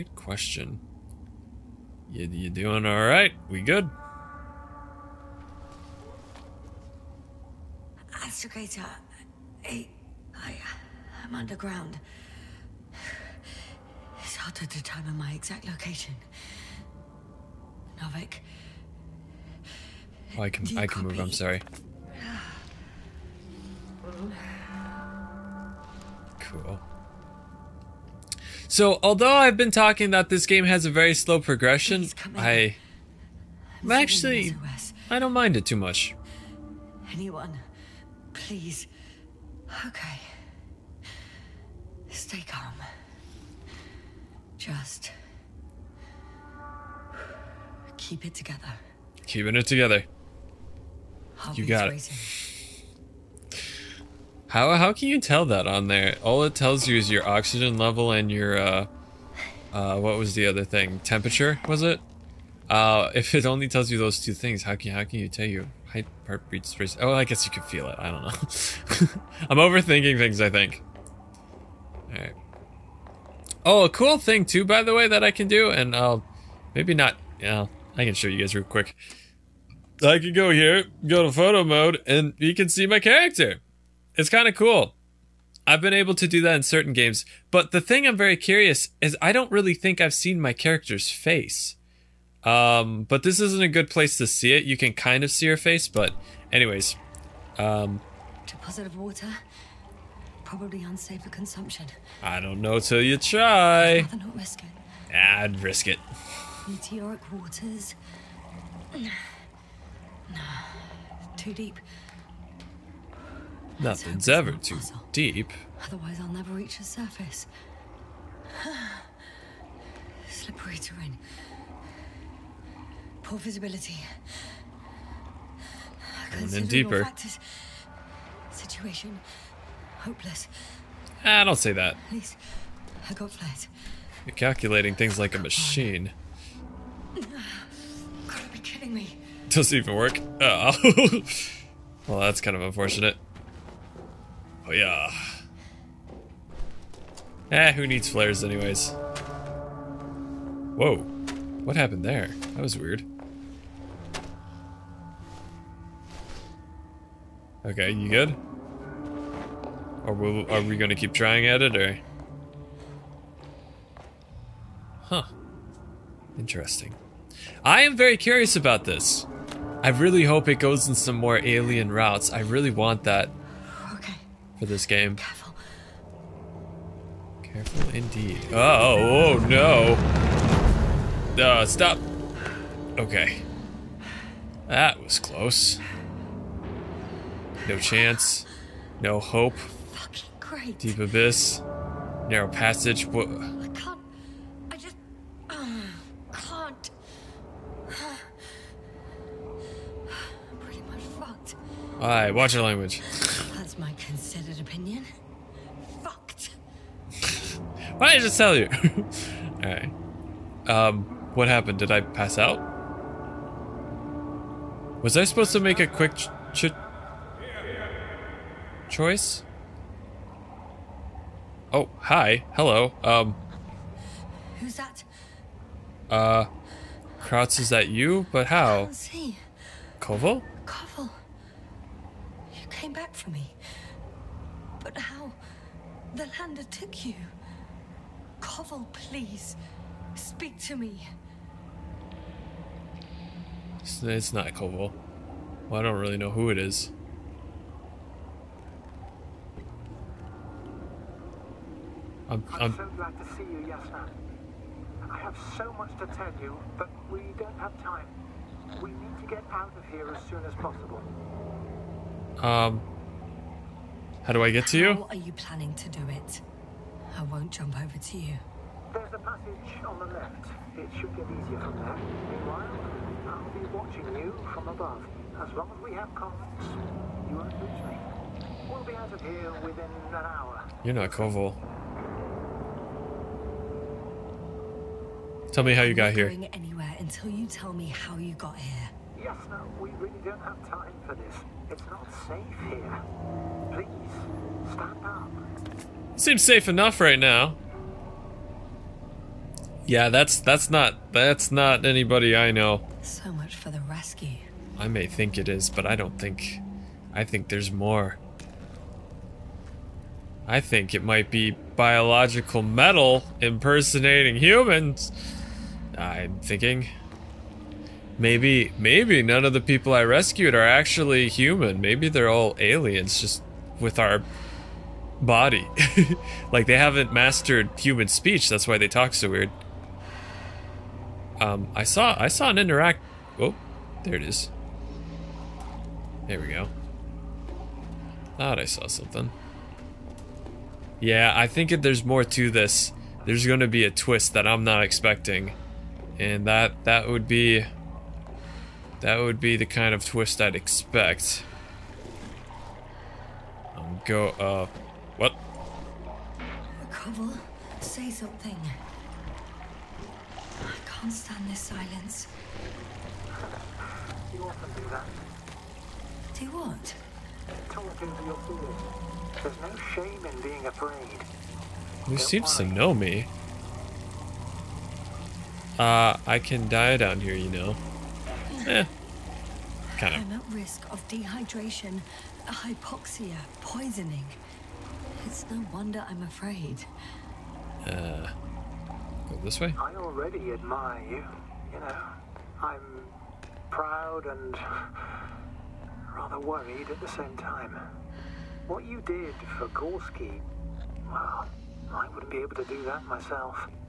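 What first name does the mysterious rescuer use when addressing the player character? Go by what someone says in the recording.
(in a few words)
Yasna.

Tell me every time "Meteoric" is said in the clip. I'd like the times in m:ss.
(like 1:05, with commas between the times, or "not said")
1:46.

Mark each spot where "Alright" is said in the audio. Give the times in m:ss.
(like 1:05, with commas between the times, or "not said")
3:21, 3:29.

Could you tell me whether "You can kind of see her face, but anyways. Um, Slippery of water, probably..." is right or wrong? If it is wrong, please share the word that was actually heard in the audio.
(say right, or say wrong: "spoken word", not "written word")
wrong: "Deposit", not "Slippery".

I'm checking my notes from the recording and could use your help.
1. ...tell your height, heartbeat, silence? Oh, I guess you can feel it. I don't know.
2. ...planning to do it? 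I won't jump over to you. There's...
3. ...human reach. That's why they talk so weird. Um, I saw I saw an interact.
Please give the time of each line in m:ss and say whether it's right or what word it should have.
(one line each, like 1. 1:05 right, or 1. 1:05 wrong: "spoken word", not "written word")
1. 1:05 wrong: "space", not "silence"
2. 4:25 right
3. 5:27 wrong: "speech", not "reach".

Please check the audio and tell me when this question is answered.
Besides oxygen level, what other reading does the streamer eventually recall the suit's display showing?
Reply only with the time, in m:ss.
1:01.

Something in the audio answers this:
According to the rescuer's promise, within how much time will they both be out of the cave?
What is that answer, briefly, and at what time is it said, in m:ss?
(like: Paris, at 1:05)
An hour, at 4:39.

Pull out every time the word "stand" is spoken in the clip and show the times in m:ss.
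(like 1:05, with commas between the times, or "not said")
4:54, 6:01.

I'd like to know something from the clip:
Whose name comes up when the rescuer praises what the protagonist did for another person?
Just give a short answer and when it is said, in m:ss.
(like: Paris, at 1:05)
Gorski, at 6:39.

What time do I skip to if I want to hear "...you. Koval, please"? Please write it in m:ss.
3:57.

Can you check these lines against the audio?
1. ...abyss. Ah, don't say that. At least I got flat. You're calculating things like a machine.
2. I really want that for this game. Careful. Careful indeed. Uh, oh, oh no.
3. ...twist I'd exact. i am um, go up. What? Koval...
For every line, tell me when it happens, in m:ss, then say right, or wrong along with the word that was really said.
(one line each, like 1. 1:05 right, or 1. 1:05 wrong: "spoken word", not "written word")
1. 2:10 wrong: "hopeless", not "abyss"
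2. 2:52 right
3. 5:50 wrong: "expect", not "exact".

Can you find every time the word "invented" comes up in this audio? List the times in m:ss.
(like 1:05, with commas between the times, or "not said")
not said.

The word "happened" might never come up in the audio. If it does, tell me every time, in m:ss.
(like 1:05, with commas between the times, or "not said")
2:31, 3:31.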